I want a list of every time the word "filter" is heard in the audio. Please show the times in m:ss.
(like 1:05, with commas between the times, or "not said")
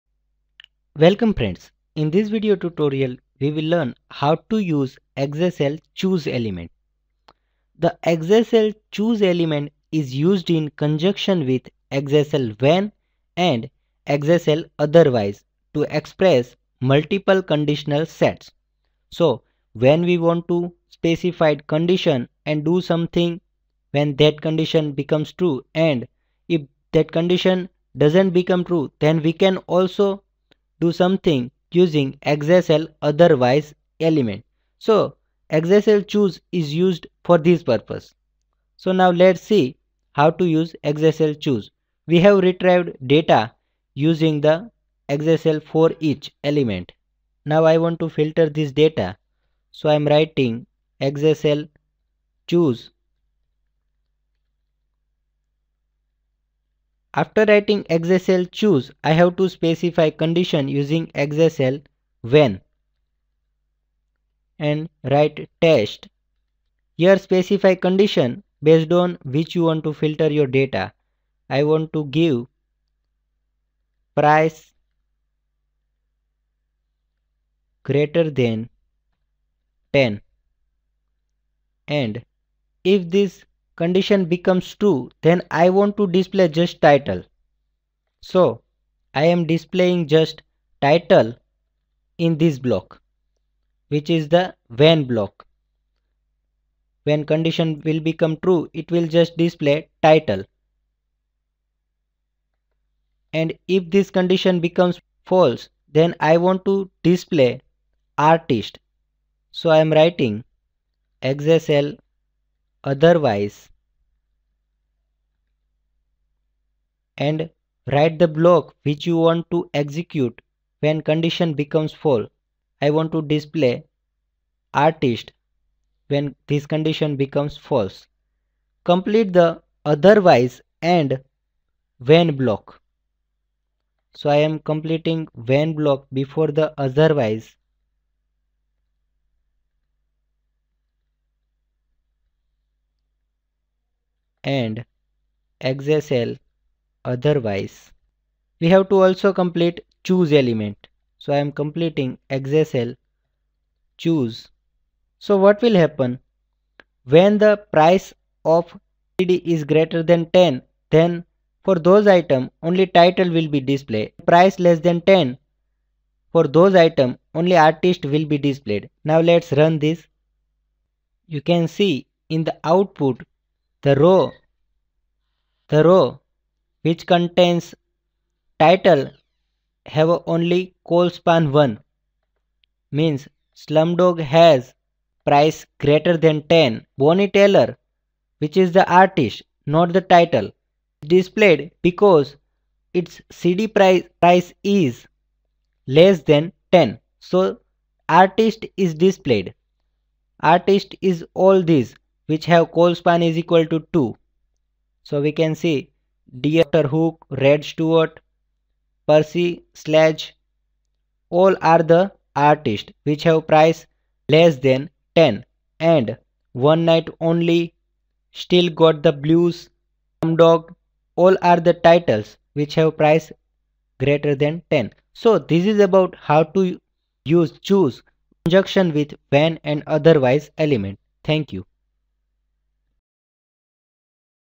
0:48, 1:09.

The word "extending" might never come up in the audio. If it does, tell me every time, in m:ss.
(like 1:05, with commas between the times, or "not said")
not said.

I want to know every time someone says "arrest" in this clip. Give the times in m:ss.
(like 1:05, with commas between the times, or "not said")
not said.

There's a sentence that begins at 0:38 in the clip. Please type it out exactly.
So now let's see how to use xsl choose.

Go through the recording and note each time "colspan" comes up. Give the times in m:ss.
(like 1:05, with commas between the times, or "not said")
3:00, 3:22.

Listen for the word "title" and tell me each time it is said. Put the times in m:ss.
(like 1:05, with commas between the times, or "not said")
1:26, 1:30, 1:40, 2:42, 2:58, 3:10, 3:41.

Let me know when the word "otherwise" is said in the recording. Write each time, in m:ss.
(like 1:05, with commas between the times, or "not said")
0:14, 0:33, 1:52, 2:09, 2:16, 2:27, 3:49.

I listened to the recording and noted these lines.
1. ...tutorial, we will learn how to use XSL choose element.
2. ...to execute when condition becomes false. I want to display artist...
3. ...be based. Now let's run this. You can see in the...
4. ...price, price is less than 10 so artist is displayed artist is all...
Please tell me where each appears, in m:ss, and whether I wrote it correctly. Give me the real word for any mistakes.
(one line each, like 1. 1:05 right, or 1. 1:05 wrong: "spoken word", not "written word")
1. 0:02 right
2. 1:59 right
3. 2:48 wrong: "displayed", not "based"
4. 3:13 right.